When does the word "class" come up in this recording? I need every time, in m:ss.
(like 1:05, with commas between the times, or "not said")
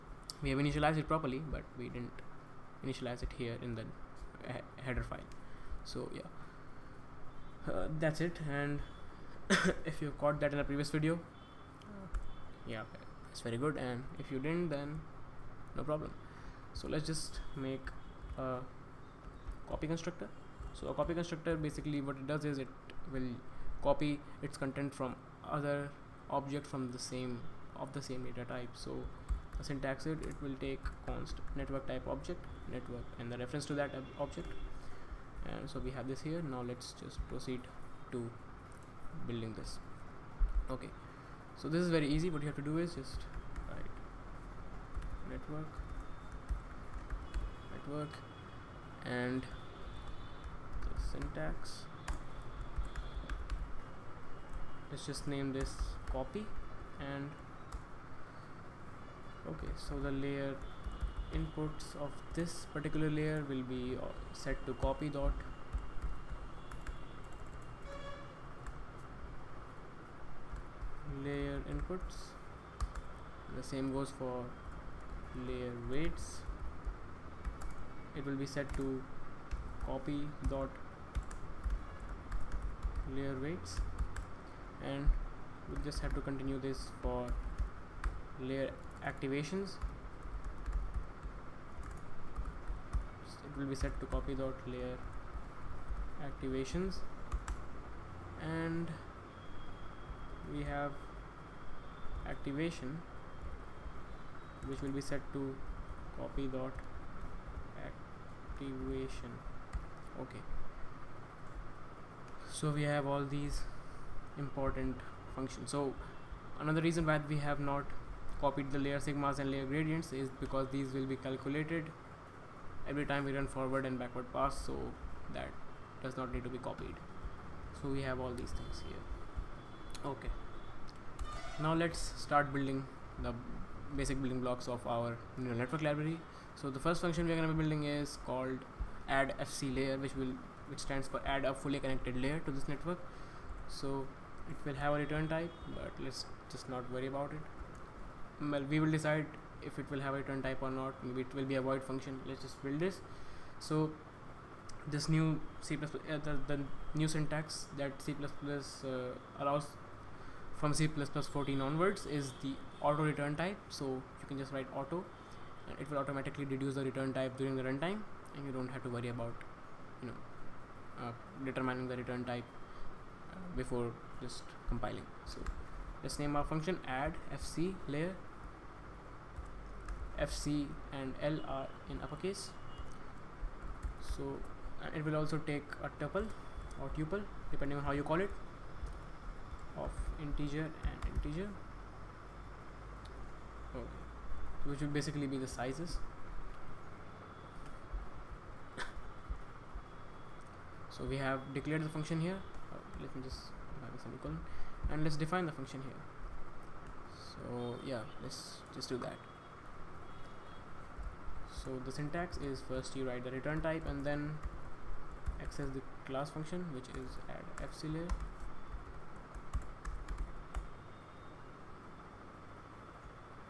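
3:36.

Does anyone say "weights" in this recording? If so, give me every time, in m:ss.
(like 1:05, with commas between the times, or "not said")
1:15, 1:23.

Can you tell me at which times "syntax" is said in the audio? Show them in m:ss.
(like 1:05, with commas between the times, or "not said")
0:29, 0:51, 2:37, 3:31.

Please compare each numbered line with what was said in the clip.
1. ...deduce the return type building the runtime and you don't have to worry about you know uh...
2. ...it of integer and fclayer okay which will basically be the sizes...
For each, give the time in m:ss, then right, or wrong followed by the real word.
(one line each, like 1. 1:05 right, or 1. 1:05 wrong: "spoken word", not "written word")
1. 2:46 wrong: "during", not "building"
2. 3:08 wrong: "integer", not "fclayer".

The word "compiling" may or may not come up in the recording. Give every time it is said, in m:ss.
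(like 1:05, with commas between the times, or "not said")
2:54.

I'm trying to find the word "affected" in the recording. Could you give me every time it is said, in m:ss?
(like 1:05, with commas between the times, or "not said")
not said.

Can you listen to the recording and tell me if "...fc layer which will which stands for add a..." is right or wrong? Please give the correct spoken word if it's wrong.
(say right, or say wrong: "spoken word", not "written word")
right.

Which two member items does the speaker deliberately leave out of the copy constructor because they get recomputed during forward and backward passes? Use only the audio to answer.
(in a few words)
layer sigmas and layer gradients.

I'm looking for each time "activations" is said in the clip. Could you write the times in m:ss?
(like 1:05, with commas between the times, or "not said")
1:29, 1:36, 1:42, 1:47.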